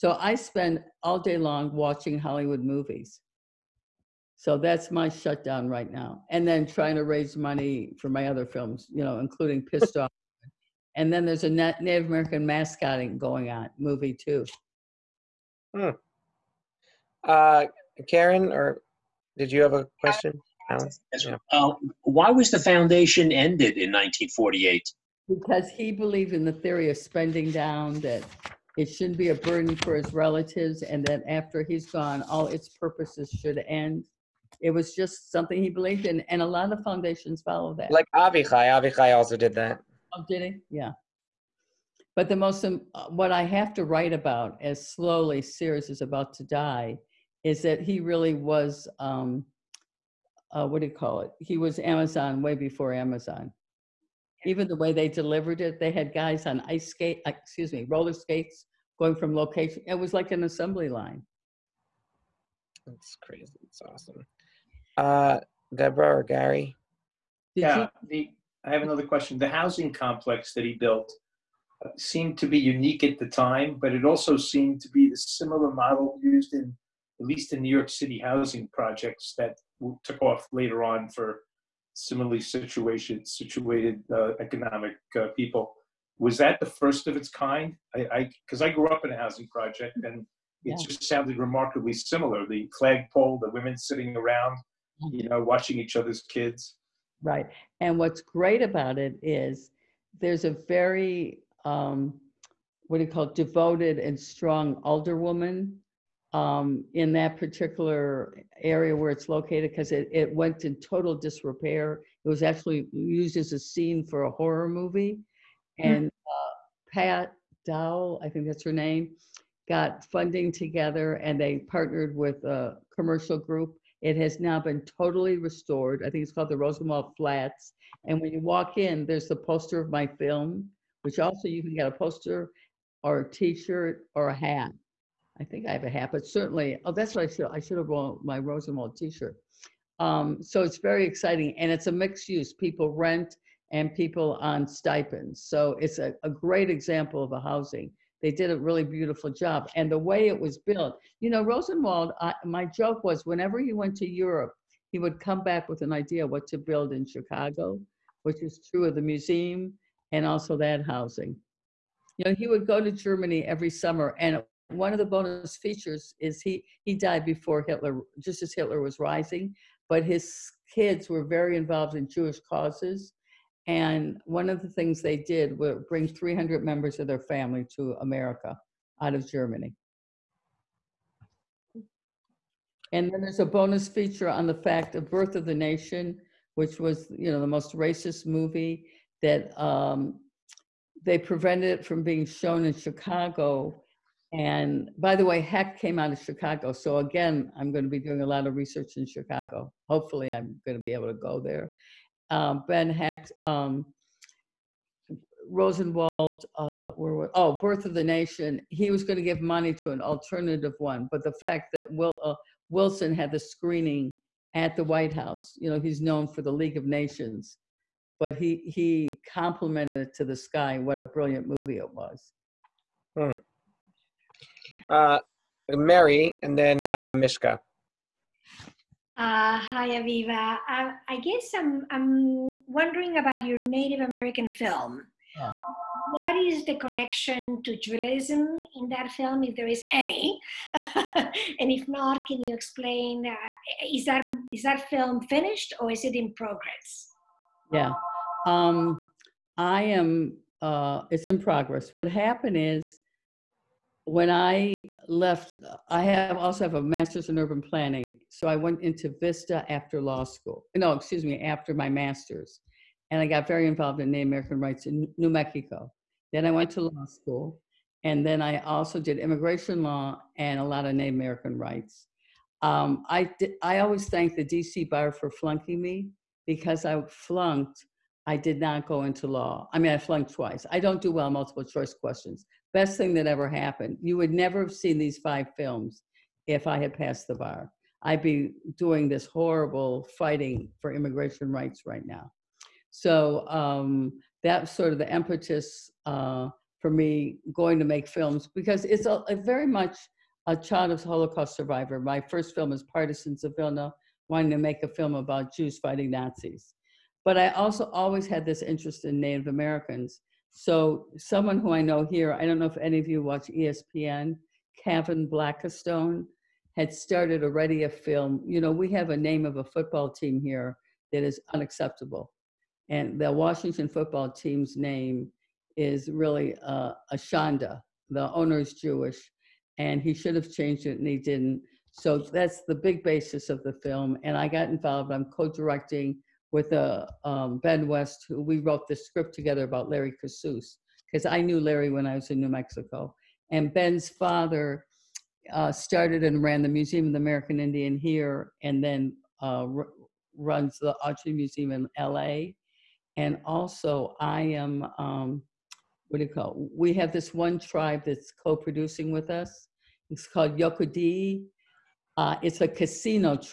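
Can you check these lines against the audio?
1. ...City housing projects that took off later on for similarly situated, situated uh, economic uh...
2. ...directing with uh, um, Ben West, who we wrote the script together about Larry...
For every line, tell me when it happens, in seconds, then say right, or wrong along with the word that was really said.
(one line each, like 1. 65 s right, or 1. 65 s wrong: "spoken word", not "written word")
1. 77 s right
2. 335 s right.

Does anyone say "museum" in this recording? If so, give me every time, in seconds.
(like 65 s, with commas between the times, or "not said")
159 s, 346 s, 351 s.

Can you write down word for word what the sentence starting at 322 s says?
And the Washington football team's name is really uh, a shanda.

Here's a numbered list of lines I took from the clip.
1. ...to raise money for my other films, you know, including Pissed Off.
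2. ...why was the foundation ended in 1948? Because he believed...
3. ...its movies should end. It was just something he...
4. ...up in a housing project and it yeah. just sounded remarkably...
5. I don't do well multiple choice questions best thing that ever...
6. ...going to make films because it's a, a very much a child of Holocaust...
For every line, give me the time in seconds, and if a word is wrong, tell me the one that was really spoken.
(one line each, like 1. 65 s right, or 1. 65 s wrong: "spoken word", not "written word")
1. 6 s right
2. 22 s right
3. 32 s wrong: "purposes", not "movies"
4. 88 s right
5. 280 s right
6. 297 s right.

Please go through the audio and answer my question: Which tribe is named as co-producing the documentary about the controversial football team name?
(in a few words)
Yocha Dehe.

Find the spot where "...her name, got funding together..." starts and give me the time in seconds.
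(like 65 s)
118 s.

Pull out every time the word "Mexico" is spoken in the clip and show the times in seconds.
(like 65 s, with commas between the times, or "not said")
265 s, 342 s.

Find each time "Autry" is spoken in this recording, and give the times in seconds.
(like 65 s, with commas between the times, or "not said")
351 s.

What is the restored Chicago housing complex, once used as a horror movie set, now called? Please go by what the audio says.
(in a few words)
Rosenwald Flats.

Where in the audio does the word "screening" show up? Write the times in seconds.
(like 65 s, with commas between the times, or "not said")
213 s.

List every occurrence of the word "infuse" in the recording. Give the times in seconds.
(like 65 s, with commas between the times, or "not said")
not said.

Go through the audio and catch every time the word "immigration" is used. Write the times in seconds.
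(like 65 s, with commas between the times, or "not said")
269 s, 290 s.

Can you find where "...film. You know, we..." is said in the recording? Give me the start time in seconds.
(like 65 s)
317 s.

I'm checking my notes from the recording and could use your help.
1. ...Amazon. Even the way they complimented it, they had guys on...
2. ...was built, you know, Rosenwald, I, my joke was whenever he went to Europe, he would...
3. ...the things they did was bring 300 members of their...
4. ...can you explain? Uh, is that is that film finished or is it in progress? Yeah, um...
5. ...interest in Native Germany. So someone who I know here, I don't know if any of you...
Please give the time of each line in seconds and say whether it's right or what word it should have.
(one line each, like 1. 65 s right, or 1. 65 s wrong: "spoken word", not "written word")
1. 52 s wrong: "delivered", not "complimented"
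2. 150 s right
3. 174 s right
4. 242 s right
5. 308 s wrong: "Americans", not "Germany".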